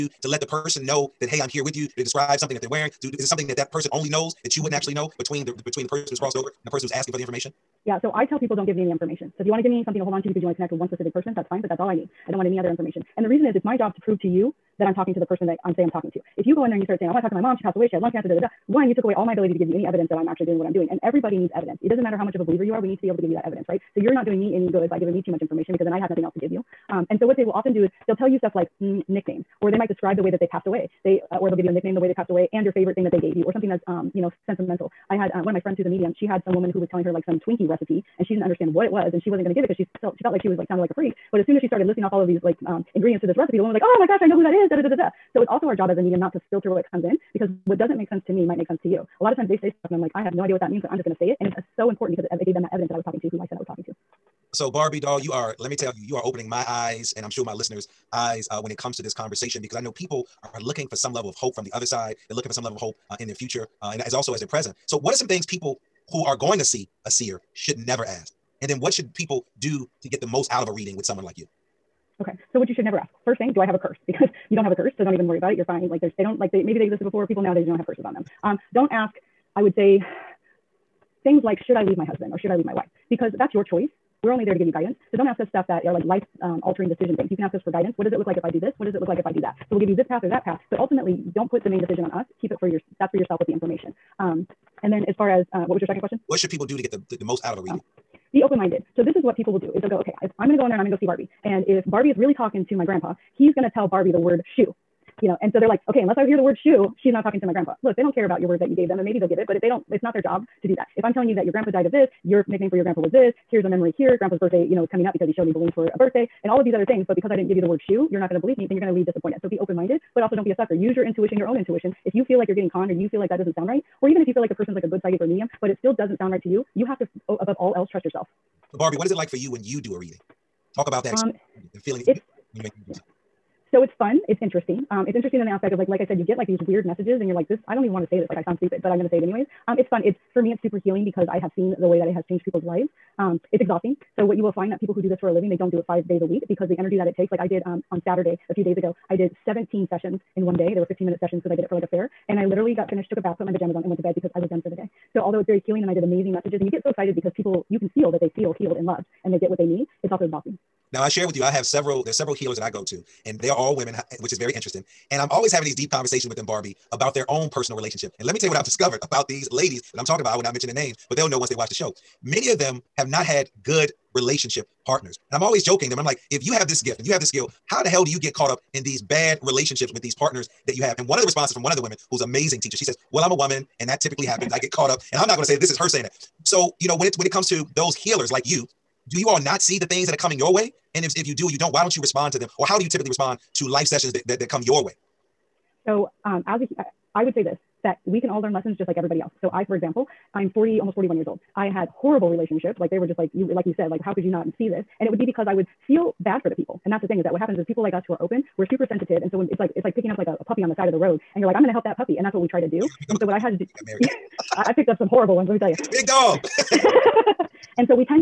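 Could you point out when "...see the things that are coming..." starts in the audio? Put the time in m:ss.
3:09.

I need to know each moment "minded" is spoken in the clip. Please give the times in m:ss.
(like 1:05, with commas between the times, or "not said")
1:38, 1:59.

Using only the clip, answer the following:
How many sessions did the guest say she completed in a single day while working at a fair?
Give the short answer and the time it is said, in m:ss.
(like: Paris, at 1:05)
17, at 2:29.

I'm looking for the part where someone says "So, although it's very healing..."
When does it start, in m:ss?
2:35.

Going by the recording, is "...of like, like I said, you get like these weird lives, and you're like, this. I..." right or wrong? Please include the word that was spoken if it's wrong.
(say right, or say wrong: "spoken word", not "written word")
wrong: "messages", not "lives".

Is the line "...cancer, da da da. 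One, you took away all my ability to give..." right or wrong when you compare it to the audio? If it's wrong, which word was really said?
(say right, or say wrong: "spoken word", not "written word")
right.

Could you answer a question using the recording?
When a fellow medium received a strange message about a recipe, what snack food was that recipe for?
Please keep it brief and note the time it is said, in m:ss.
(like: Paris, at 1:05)
Twinkie, at 0:37.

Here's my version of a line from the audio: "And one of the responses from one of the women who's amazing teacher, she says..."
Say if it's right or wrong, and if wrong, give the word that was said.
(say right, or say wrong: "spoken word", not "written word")
right.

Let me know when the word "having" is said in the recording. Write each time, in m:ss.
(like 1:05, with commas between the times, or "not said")
2:45.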